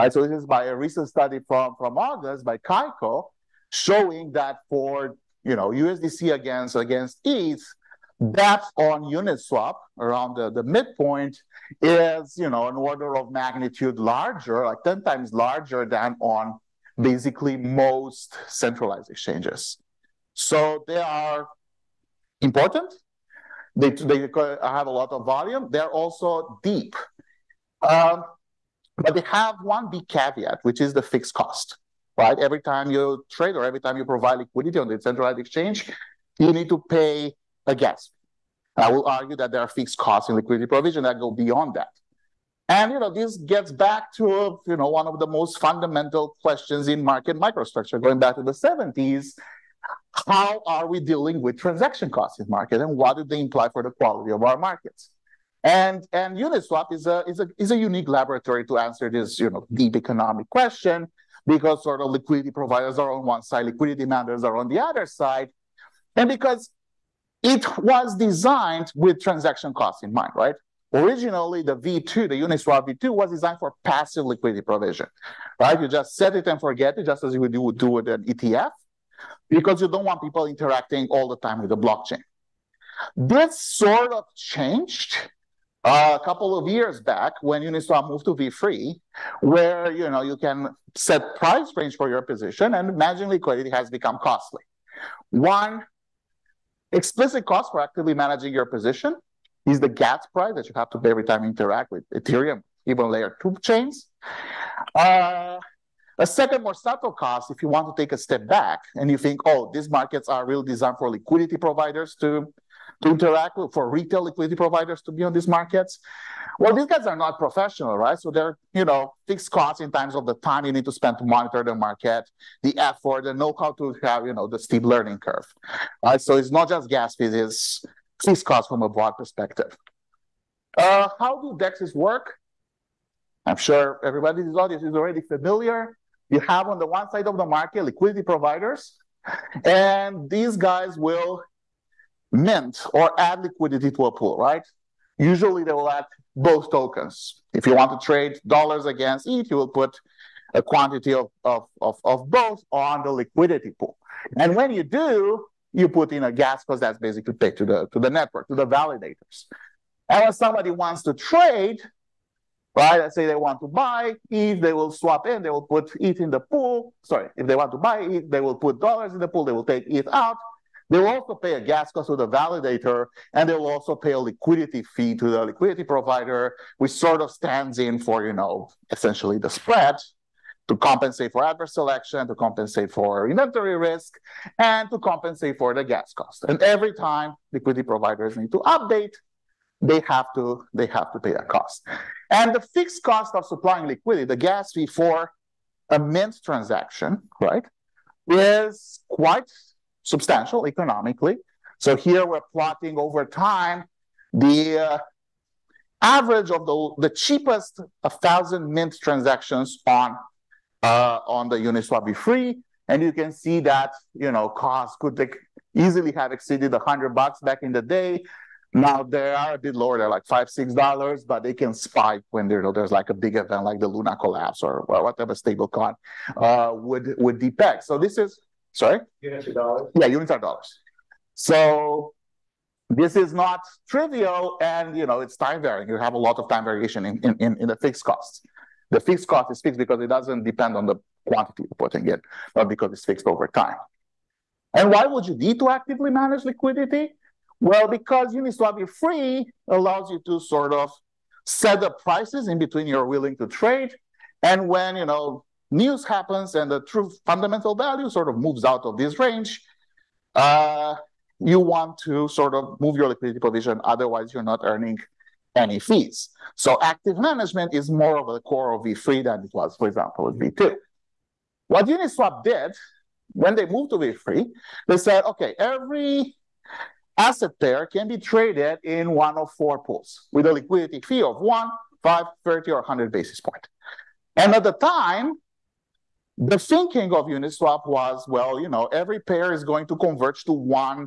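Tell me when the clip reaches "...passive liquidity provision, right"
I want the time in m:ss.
1:13.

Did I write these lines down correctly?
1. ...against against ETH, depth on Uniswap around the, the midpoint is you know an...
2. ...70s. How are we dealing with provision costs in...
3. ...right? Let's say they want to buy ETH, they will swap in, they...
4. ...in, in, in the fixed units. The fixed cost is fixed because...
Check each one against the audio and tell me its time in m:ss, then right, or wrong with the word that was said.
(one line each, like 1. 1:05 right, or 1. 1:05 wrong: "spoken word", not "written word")
1. 0:06 right
2. 0:48 wrong: "transaction", not "provision"
3. 2:42 right
4. 3:57 wrong: "costs", not "units".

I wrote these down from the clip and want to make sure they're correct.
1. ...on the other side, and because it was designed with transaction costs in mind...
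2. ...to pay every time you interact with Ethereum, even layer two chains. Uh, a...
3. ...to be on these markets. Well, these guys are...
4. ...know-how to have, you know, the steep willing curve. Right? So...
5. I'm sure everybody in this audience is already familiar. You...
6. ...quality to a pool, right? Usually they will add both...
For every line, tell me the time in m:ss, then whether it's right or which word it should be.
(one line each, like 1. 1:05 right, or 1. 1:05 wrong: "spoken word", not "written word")
1. 1:04 right
2. 1:40 right
3. 1:55 right
4. 2:03 wrong: "learning", not "willing"
5. 2:13 right
6. 2:23 wrong: "liquidity", not "quality".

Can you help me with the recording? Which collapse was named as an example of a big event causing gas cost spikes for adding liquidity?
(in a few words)
Luna collapse.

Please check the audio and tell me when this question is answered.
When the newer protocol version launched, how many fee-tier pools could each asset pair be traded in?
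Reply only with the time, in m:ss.
4:39.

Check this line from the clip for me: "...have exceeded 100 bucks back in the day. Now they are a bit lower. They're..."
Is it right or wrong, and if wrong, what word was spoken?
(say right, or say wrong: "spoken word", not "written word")
right.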